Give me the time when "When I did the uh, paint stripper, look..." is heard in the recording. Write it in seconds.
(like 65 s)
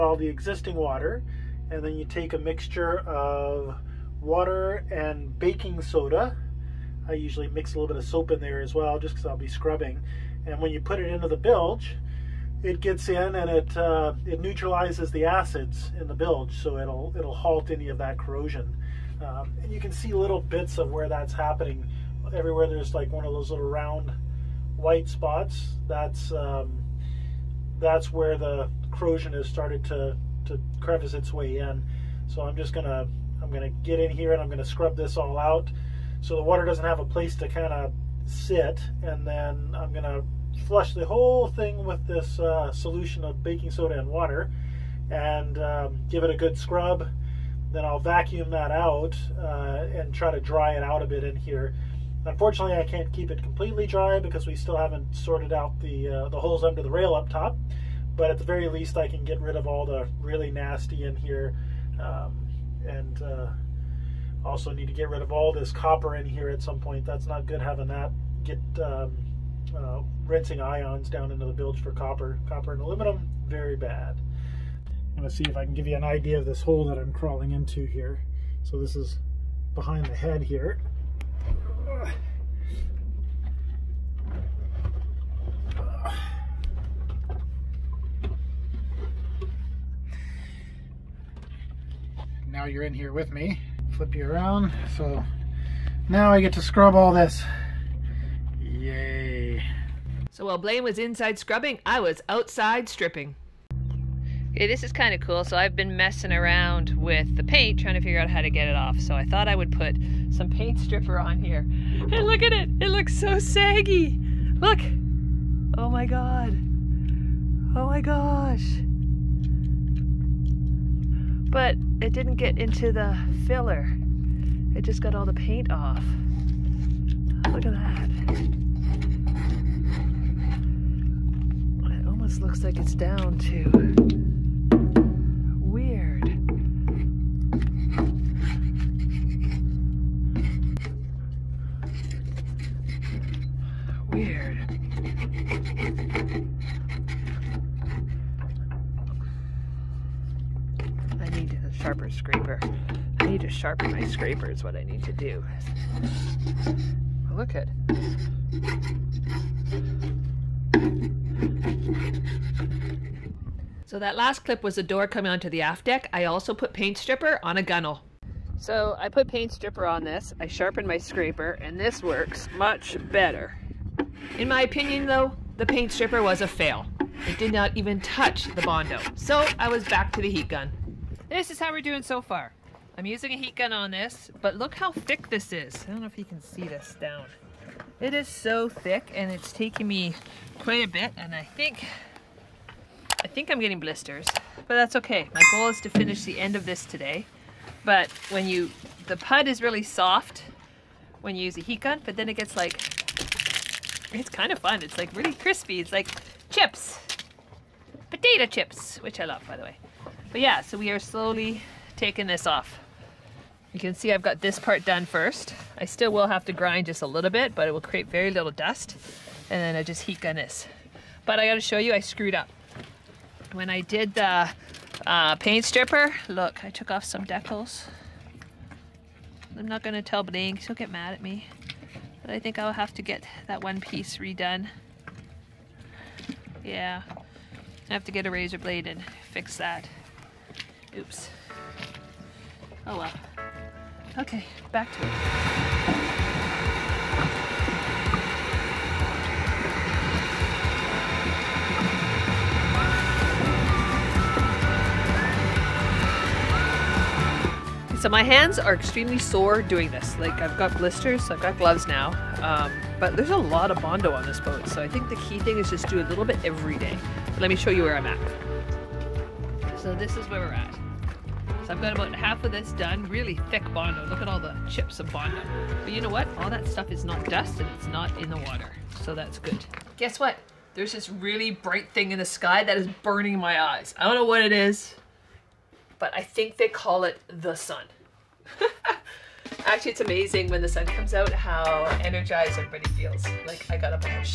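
223 s.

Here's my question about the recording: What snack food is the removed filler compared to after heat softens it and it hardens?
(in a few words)
potato chips.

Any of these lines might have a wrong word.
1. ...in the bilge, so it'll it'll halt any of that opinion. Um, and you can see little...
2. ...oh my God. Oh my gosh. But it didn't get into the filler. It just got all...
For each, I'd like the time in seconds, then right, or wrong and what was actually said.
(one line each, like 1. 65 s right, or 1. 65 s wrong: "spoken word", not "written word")
1. 16 s wrong: "corrosion", not "opinion"
2. 115 s right.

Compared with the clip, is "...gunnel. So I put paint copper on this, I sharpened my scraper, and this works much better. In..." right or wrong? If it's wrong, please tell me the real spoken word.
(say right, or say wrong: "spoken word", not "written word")
wrong: "stripper", not "copper".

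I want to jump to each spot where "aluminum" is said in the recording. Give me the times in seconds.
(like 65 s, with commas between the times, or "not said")
72 s.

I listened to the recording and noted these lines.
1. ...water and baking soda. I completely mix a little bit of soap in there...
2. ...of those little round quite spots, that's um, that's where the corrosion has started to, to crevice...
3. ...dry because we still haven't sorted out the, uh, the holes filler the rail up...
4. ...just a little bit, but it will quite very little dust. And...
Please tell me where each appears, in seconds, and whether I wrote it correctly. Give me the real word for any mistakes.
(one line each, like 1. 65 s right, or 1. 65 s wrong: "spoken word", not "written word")
1. 4 s wrong: "usually", not "completely"
2. 23 s wrong: "white", not "quite"
3. 53 s wrong: "under", not "filler"
4. 216 s wrong: "create", not "quite".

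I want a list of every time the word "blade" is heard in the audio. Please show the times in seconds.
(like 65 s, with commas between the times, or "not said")
238 s.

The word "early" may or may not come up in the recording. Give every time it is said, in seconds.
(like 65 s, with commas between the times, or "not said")
not said.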